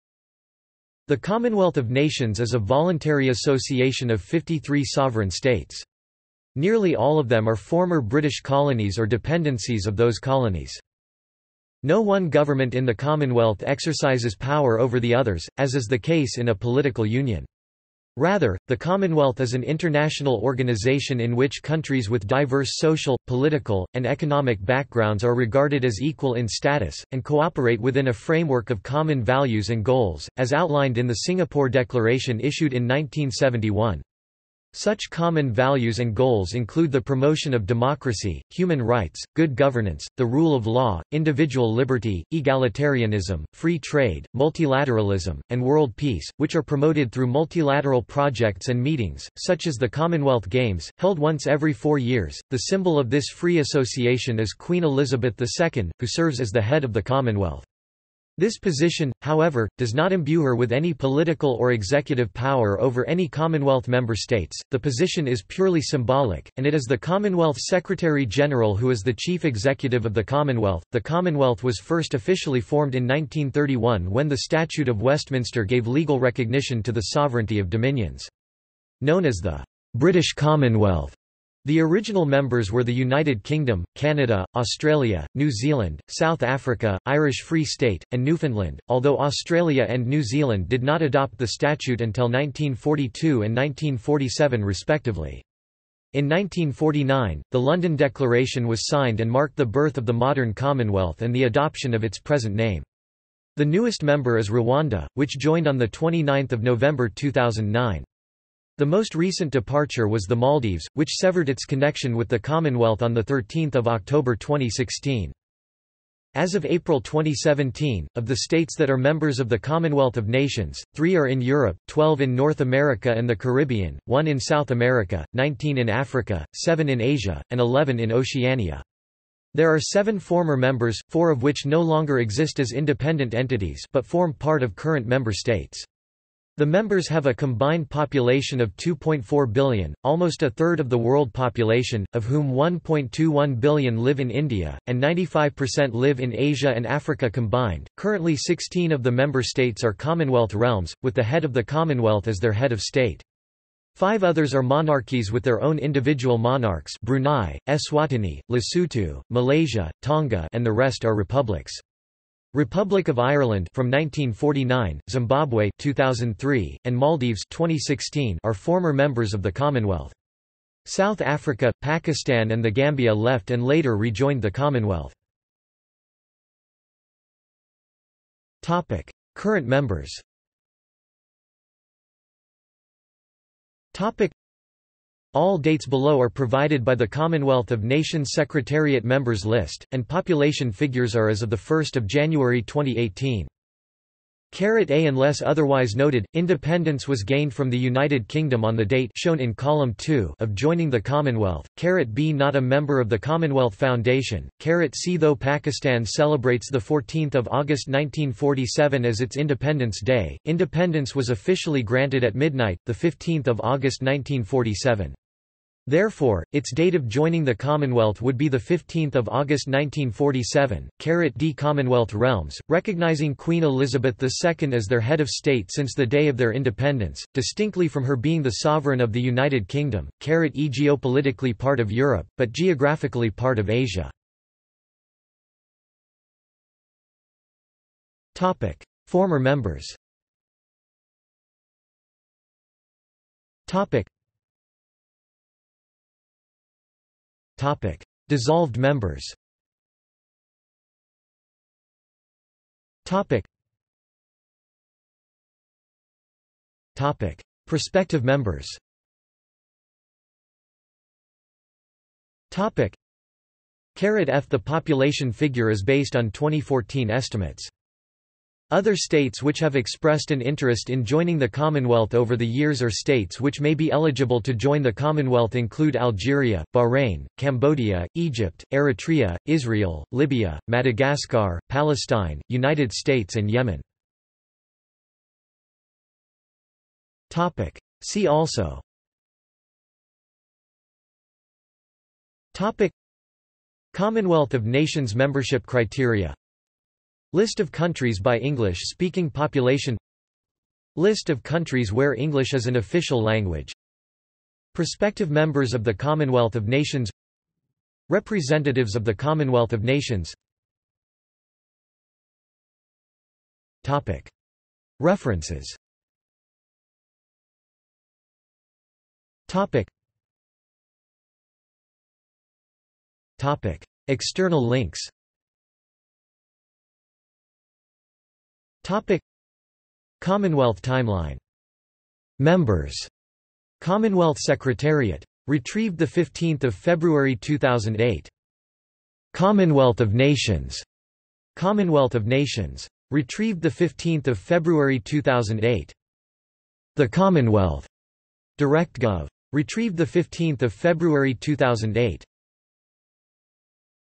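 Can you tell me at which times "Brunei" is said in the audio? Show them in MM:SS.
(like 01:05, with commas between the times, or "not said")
02:37.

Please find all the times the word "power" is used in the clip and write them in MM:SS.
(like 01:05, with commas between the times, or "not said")
00:14, 01:02.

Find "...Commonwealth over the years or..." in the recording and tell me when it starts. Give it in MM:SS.
04:31.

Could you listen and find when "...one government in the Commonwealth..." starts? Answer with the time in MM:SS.
00:11.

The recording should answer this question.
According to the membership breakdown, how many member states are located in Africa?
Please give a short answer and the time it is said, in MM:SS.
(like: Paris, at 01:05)
19, at 02:05.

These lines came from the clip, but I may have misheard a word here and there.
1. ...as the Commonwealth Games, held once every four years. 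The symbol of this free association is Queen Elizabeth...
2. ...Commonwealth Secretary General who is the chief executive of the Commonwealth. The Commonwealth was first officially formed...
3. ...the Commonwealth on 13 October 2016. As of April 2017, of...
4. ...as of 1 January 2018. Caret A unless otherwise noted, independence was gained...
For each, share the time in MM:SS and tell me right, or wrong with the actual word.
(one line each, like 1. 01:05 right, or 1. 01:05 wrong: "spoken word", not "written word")
1. 00:49 right
2. 01:06 right
3. 01:52 right
4. 03:11 right.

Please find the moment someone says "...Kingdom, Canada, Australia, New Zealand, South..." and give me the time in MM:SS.
01:23.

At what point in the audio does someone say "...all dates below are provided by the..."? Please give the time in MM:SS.
03:05.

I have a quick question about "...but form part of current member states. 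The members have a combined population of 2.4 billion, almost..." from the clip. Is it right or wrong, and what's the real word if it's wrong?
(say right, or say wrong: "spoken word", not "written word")
right.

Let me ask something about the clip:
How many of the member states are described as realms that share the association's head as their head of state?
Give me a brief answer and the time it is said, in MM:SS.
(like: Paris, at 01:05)
16, at 02:28.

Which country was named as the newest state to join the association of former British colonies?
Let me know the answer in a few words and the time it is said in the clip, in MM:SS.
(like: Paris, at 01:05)
Rwanda, at 01:44.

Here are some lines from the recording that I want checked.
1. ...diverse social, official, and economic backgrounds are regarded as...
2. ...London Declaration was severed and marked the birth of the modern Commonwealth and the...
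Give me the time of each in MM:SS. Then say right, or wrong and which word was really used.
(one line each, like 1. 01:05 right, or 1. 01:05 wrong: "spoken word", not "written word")
1. 00:22 wrong: "political", not "official"
2. 01:37 wrong: "signed", not "severed".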